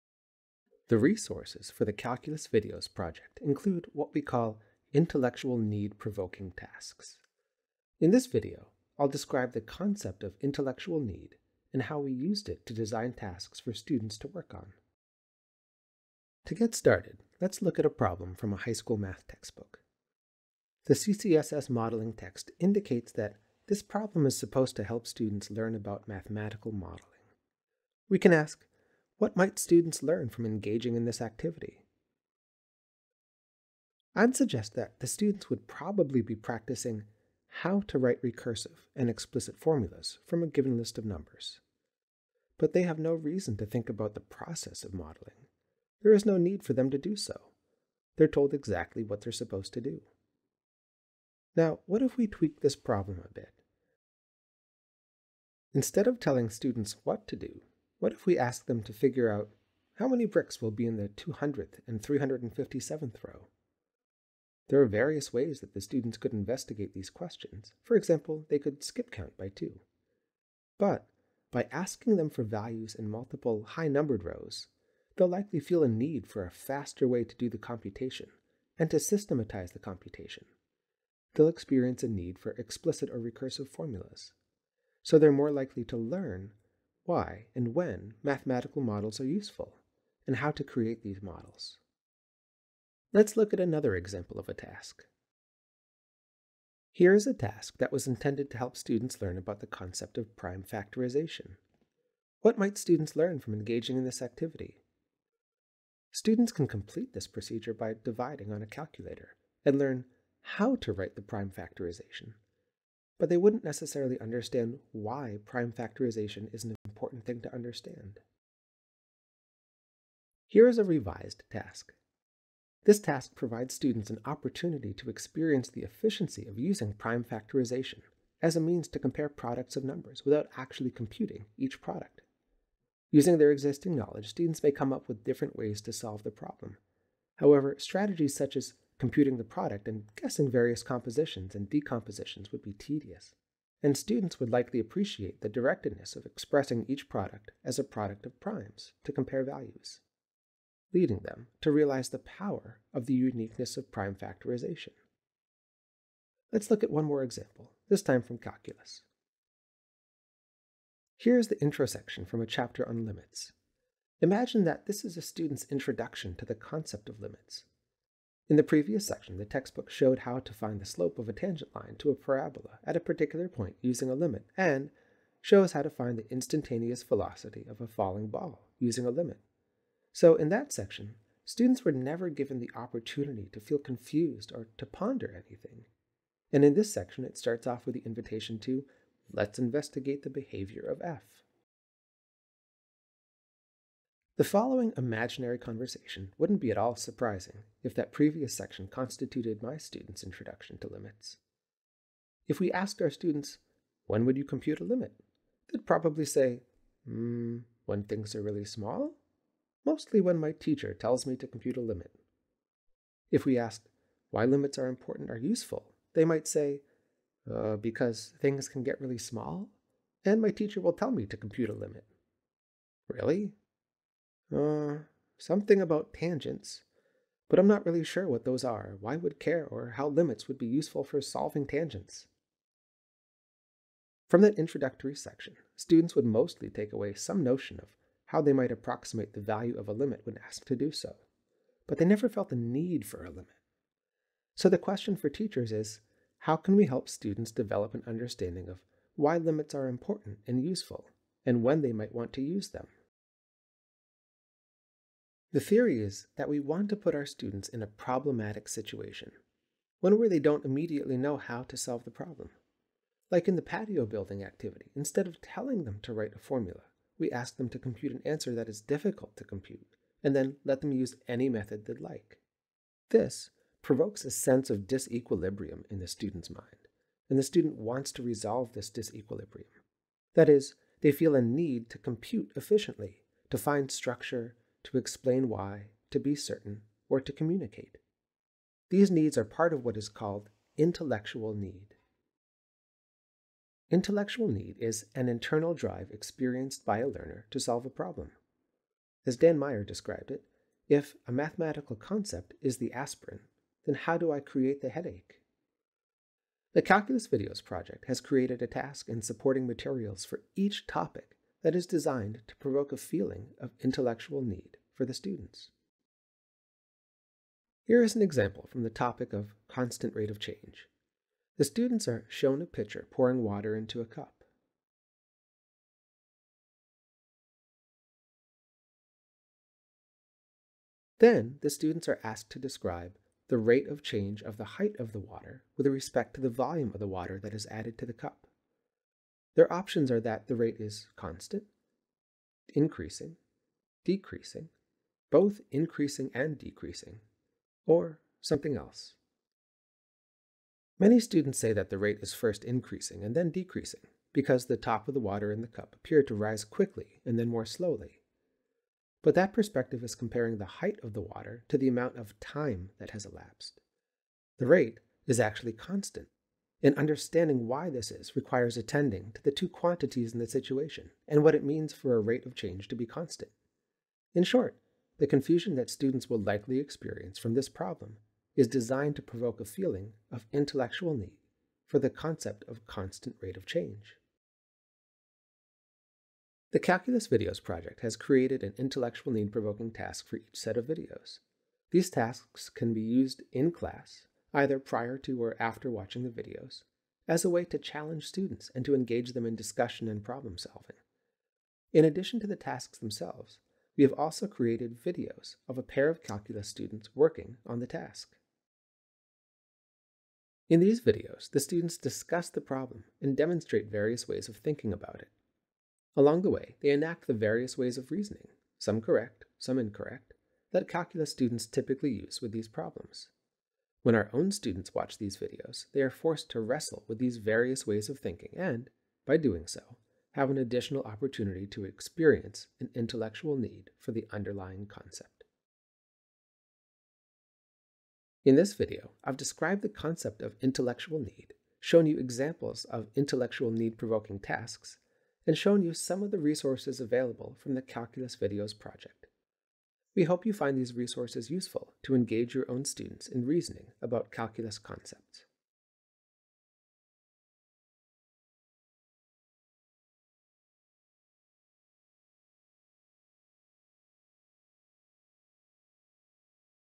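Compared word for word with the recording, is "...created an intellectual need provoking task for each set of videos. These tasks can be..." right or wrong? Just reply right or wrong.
right.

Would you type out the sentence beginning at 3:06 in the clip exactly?
And in this section, it starts off with the invitation to let's investigate the behavior of F.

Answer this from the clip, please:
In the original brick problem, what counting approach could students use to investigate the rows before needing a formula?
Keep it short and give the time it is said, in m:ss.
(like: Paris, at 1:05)
skip count by two, at 1:08.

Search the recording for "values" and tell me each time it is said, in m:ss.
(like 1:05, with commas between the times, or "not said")
1:12, 2:29, 3:59.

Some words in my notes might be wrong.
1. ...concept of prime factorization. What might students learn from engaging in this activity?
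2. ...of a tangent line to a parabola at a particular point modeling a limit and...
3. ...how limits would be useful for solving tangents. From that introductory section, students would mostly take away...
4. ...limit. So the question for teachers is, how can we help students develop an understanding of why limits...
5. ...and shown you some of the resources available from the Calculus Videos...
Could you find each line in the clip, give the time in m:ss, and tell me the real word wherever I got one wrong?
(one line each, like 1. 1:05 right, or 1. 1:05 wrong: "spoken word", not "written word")
1. 1:39 right
2. 2:51 wrong: "using", not "modeling"
3. 3:49 right
4. 4:03 right
5. 7:25 right.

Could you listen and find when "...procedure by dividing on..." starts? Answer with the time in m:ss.
1:47.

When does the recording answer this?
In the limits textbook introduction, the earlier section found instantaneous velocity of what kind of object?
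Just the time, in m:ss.
2:57.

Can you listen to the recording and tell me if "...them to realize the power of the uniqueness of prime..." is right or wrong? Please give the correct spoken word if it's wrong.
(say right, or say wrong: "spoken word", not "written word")
right.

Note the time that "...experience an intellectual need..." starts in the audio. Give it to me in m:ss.
7:11.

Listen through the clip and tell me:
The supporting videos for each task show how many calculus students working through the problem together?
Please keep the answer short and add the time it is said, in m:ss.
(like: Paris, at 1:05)
2, at 6:45.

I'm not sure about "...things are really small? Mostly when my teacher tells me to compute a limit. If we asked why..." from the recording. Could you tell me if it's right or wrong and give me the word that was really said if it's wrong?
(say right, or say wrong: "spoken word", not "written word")
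right.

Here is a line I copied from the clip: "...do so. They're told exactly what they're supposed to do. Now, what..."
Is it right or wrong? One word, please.
right.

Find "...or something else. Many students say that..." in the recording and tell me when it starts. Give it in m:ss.
5:47.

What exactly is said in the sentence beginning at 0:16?
To get started, let's look at a problem from a high school math textbook.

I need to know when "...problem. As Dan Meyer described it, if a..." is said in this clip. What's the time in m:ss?
4:57.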